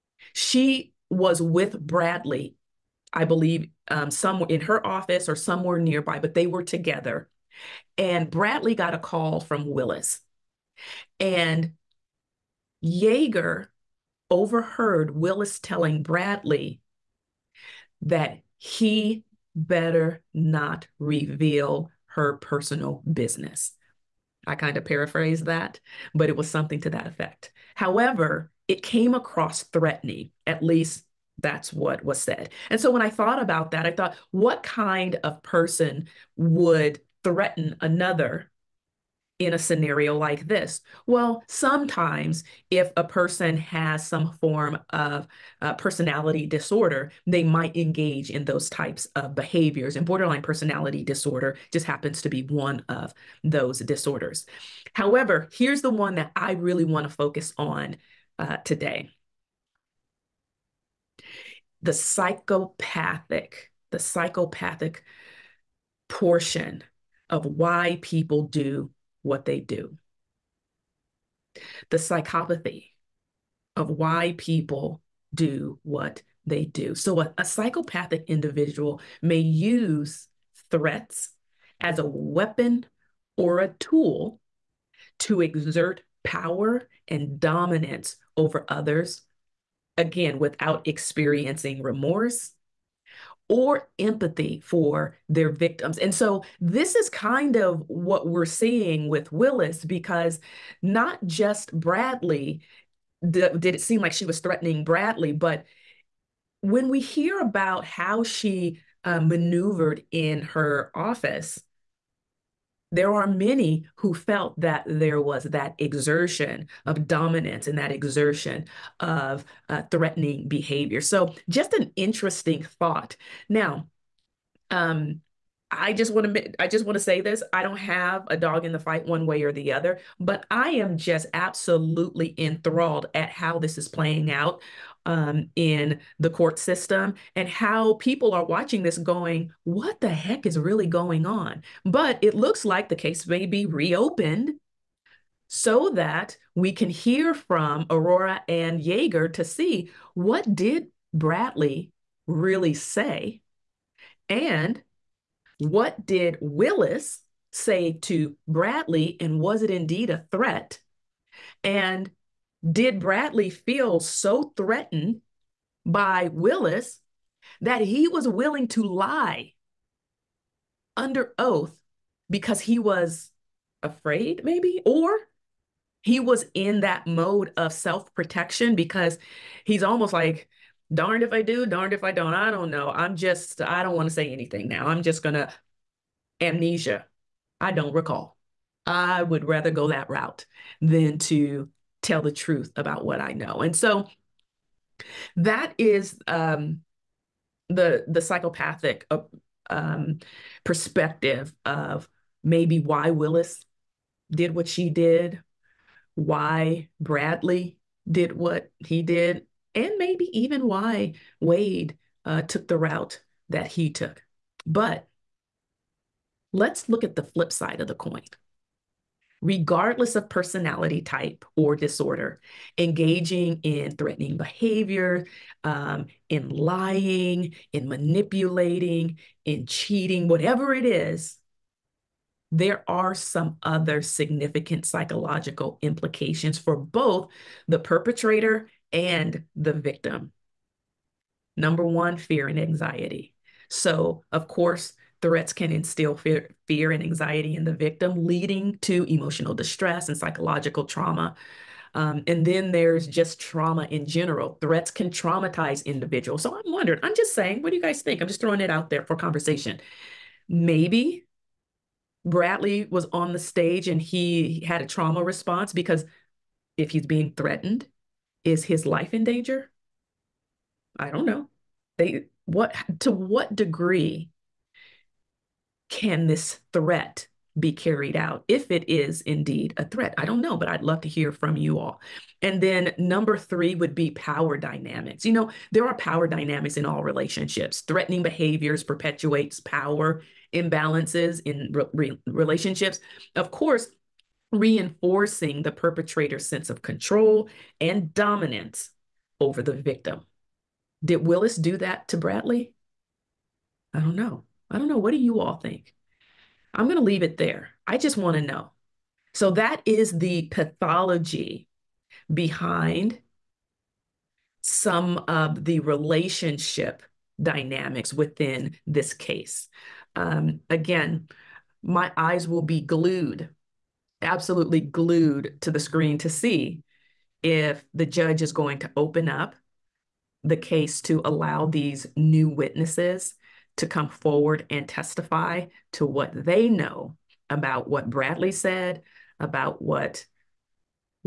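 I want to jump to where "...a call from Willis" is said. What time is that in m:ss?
0:08.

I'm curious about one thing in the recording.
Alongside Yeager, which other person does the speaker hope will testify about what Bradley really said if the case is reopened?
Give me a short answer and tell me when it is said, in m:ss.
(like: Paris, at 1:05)
Arora, at 2:27.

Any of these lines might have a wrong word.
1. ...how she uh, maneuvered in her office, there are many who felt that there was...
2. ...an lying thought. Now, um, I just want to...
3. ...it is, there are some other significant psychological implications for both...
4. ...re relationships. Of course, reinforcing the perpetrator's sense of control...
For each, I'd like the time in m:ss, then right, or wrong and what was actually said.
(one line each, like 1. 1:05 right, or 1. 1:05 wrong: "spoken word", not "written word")
1. 1:47 right
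2. 2:01 wrong: "interesting", not "lying"
3. 3:50 right
4. 4:51 right.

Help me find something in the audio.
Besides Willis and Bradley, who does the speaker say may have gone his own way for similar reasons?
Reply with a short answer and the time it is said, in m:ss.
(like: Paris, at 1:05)
Wade, at 3:31.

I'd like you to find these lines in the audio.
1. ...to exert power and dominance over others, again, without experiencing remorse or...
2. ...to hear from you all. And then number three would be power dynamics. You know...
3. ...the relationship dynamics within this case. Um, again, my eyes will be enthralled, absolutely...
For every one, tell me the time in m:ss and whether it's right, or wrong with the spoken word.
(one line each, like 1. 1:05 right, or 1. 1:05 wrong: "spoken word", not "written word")
1. 1:25 right
2. 4:41 right
3. 5:15 wrong: "glued", not "enthralled".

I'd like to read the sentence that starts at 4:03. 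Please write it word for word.
So, of course, Threats can instill fear, fear and anxiety in the victim, leading to emotional distress and psychological trauma.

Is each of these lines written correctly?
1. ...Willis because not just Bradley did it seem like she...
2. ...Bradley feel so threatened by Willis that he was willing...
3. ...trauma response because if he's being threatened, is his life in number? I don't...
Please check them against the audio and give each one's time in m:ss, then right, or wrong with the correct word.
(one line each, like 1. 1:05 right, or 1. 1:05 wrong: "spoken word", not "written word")
1. 1:39 right
2. 2:42 right
3. 4:24 wrong: "danger", not "number".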